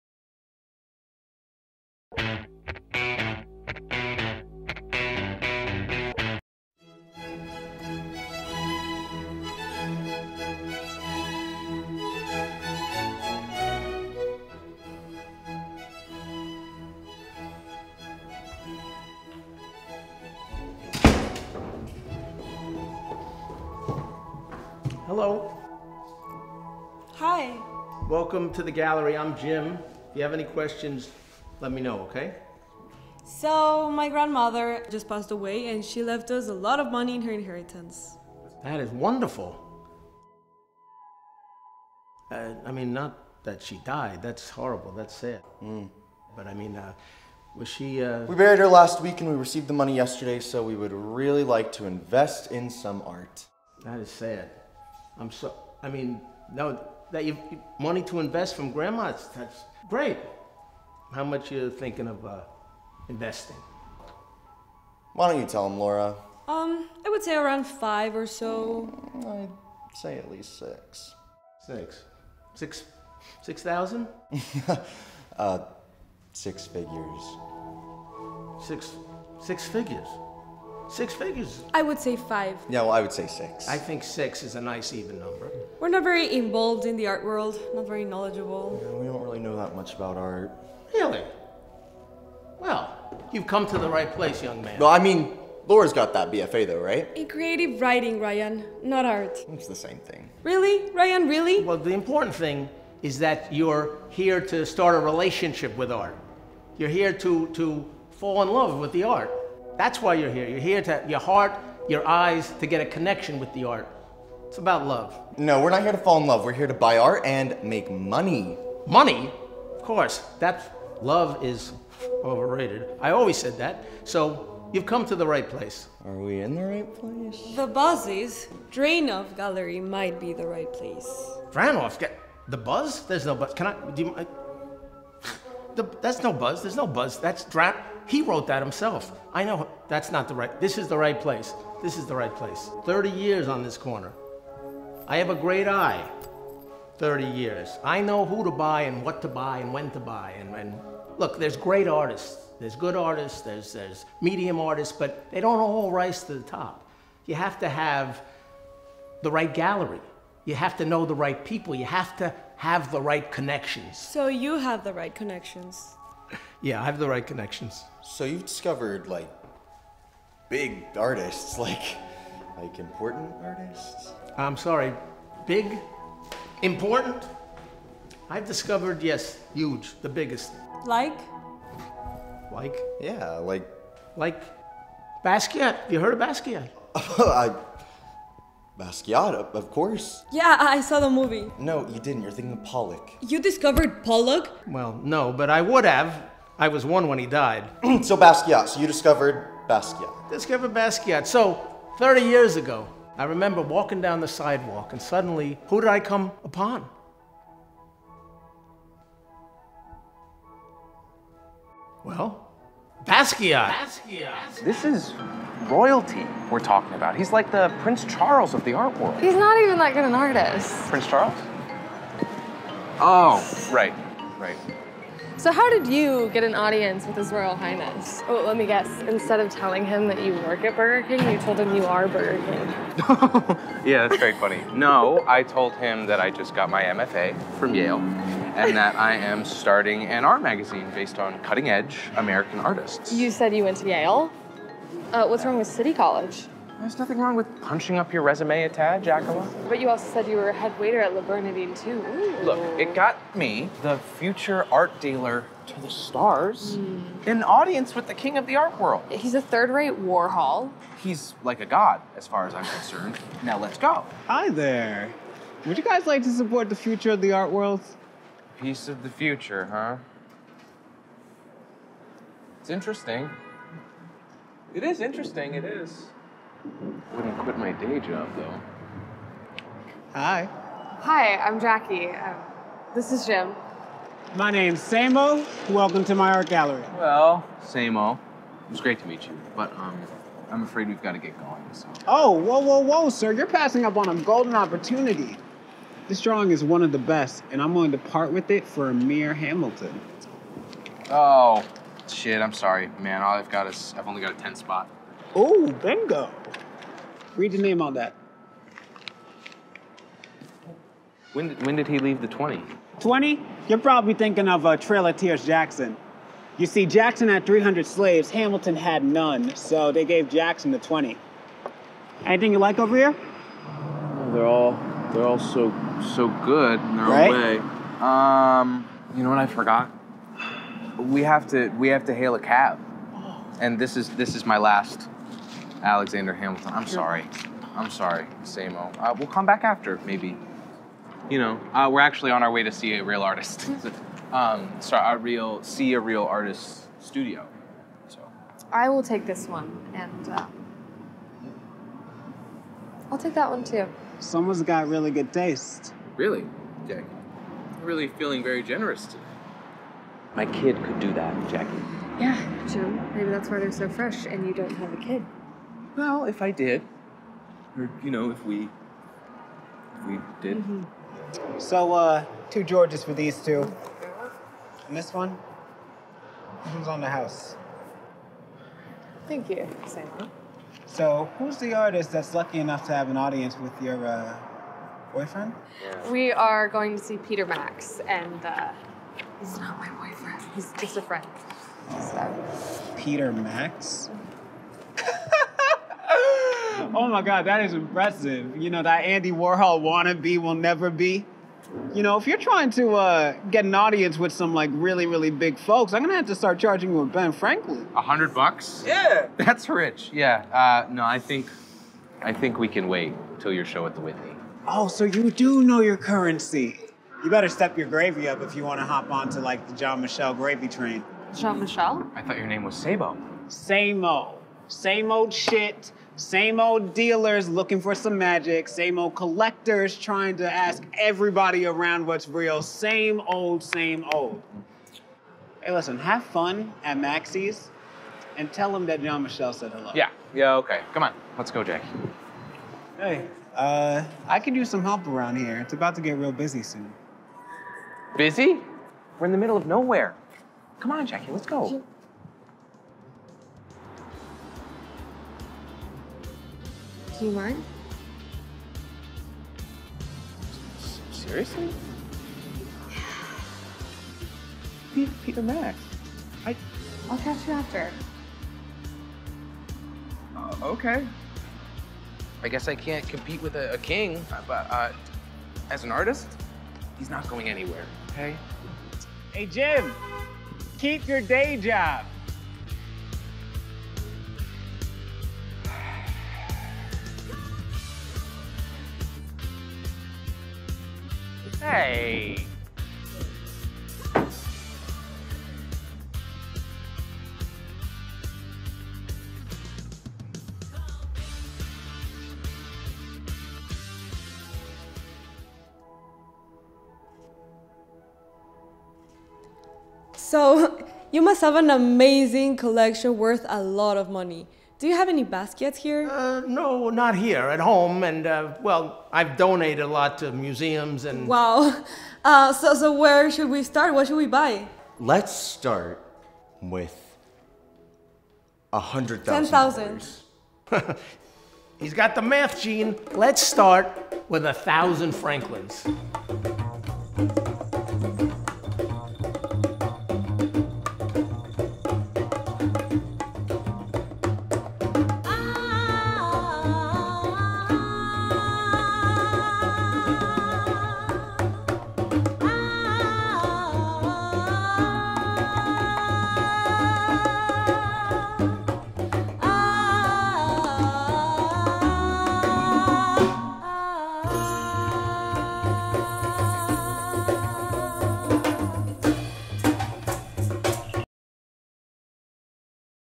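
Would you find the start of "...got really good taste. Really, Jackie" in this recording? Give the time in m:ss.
5:54.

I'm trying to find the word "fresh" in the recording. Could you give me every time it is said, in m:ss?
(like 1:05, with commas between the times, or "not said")
6:03.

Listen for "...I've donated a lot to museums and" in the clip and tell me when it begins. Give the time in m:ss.
8:39.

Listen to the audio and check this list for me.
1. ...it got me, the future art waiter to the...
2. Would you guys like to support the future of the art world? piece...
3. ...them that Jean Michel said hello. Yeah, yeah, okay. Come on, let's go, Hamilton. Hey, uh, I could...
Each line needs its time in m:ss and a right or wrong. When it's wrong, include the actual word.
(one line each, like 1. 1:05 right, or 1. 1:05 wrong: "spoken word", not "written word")
1. 4:12 wrong: "dealer", not "waiter"
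2. 4:25 right
3. 7:18 wrong: "Jackie", not "Hamilton".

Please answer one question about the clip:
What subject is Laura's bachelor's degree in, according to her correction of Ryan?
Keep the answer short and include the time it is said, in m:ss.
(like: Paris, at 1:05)
Creative writing, at 1:37.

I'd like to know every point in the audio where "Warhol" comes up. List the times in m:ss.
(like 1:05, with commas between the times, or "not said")
4:20, 6:39.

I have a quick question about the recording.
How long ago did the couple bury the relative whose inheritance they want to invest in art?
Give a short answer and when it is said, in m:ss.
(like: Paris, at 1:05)
Last week, at 0:48.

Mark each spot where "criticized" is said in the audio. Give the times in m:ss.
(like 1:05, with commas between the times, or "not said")
not said.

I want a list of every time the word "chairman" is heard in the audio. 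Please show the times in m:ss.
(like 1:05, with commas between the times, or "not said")
not said.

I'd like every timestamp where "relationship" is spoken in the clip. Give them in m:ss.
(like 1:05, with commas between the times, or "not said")
1:44.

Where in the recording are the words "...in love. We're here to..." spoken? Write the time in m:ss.
1:56.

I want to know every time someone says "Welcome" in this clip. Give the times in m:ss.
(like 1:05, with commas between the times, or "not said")
0:28, 4:45.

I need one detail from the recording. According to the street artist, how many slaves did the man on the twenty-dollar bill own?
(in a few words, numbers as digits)
300.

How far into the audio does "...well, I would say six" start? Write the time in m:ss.
1:22.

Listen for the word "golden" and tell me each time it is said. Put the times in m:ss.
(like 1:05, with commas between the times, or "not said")
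4:54.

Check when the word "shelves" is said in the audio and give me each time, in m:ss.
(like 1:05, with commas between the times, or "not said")
not said.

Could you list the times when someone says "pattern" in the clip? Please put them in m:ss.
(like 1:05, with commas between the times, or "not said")
not said.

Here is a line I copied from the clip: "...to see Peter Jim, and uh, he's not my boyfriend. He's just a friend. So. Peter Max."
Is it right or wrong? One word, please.
wrong.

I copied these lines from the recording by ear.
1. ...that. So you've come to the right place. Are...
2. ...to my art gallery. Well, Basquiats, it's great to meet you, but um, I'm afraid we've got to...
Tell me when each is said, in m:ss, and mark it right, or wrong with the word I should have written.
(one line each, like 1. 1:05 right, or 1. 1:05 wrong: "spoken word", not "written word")
1. 2:03 right
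2. 4:46 wrong: "Samo", not "Basquiats".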